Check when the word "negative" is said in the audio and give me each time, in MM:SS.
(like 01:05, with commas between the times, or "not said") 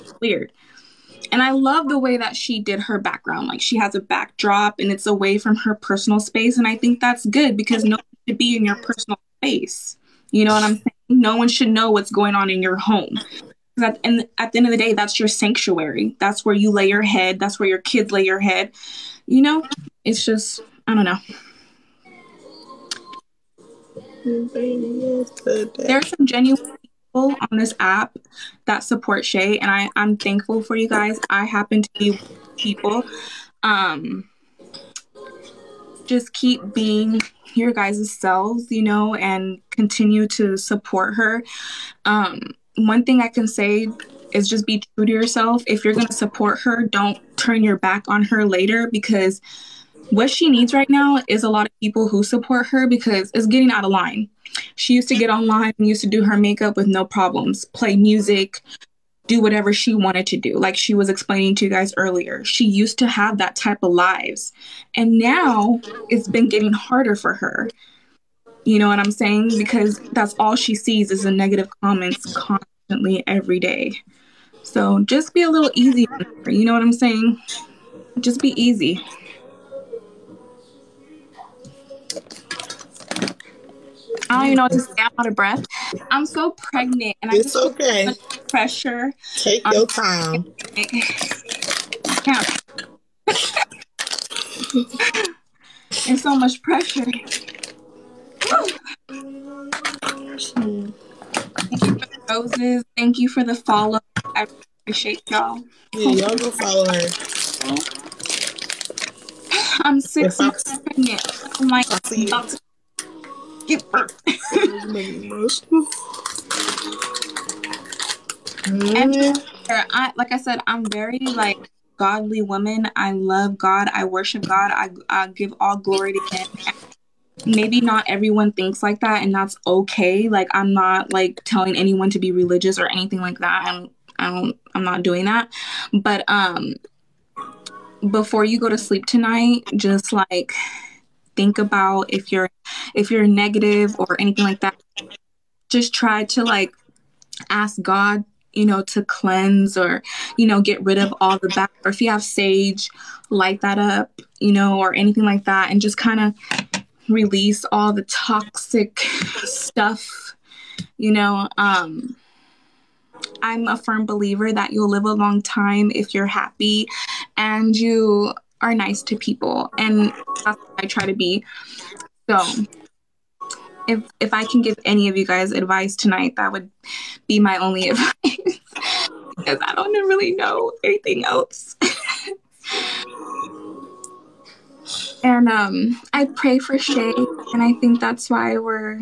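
01:11, 02:23.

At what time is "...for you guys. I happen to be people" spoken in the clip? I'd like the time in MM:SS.
00:30.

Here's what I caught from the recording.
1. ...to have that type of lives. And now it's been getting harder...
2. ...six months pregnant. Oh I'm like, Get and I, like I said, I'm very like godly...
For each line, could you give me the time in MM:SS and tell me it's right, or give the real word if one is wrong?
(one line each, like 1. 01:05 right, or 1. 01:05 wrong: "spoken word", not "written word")
1. 01:02 right
2. 01:49 right.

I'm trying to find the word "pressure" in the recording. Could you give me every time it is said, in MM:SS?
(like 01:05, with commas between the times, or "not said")
01:28, 01:36.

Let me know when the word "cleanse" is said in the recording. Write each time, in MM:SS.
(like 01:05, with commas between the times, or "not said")
02:29.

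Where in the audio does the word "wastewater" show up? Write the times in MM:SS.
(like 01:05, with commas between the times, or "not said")
not said.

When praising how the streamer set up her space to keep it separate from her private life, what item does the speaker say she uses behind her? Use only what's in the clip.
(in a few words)
backdrop.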